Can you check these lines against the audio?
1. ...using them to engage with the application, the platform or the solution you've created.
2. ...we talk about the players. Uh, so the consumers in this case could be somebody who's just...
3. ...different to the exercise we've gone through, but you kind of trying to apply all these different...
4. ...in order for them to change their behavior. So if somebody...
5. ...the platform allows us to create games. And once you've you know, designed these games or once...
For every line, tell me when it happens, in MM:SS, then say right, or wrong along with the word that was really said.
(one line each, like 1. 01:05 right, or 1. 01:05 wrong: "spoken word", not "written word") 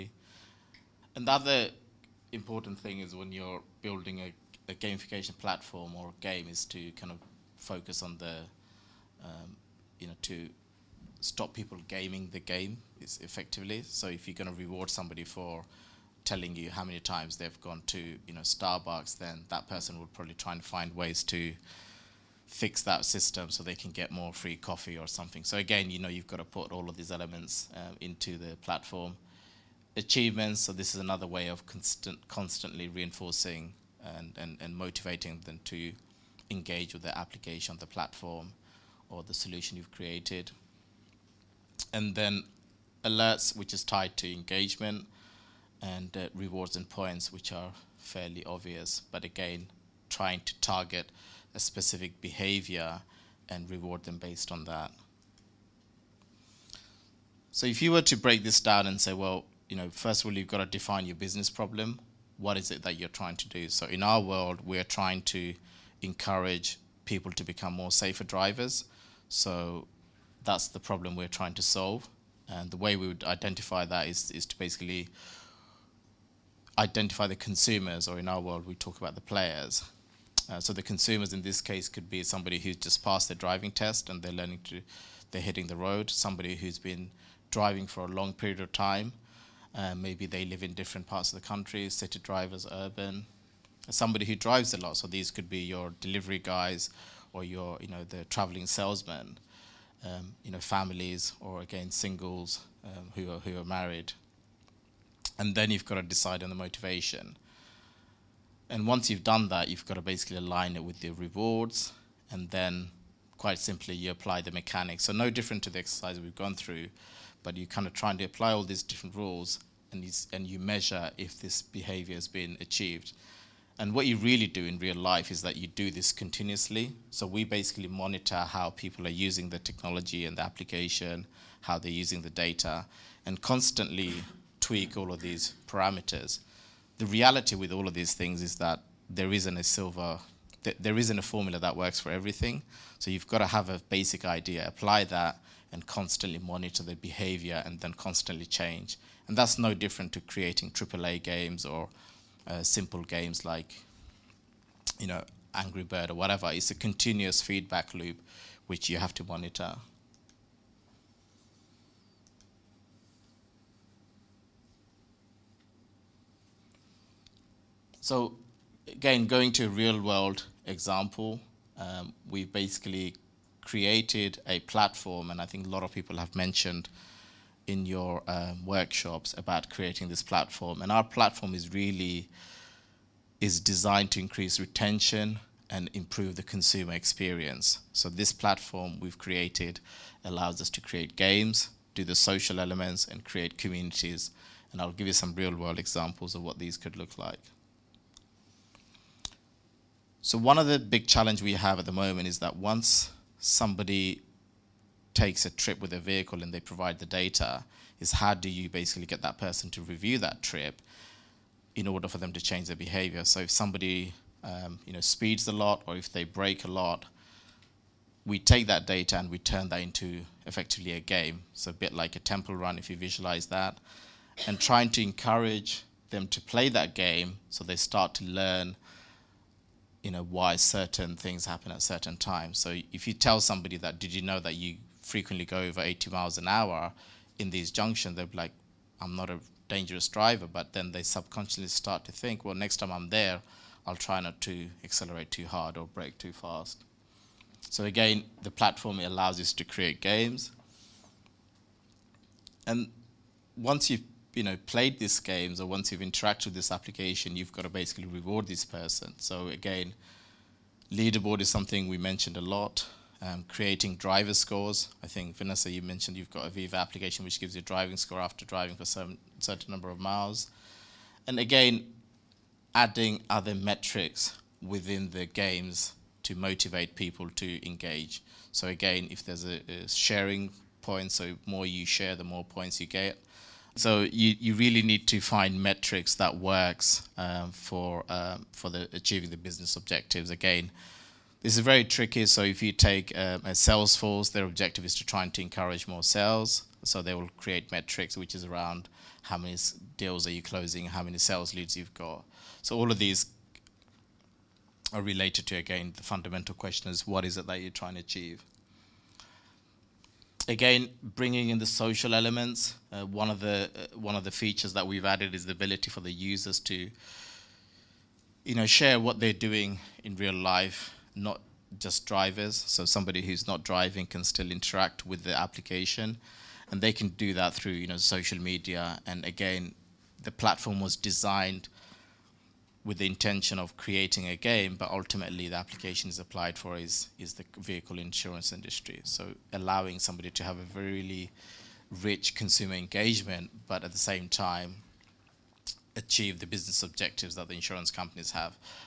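1. 00:34 wrong: "motivating", not "using"
2. 01:18 right
3. 01:55 right
4. 03:31 right
5. 04:08 wrong: "played", not "designed".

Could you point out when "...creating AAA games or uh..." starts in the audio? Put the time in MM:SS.
02:30.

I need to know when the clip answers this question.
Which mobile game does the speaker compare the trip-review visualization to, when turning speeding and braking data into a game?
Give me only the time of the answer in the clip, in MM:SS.
03:42.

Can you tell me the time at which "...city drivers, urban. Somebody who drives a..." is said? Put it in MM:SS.
01:31.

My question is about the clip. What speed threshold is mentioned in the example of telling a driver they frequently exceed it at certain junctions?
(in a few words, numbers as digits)
80 miles an hour.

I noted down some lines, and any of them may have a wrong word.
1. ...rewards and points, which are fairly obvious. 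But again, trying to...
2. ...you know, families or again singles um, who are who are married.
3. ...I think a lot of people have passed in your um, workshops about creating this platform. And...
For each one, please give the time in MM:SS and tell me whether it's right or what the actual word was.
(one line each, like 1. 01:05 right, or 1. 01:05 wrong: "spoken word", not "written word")
1. 00:46 right
2. 01:40 right
3. 02:55 wrong: "mentioned", not "passed".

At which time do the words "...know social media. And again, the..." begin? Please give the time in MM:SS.
05:27.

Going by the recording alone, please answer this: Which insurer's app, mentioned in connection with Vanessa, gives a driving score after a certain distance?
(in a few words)
Aviva.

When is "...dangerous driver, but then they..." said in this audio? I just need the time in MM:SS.
03:59.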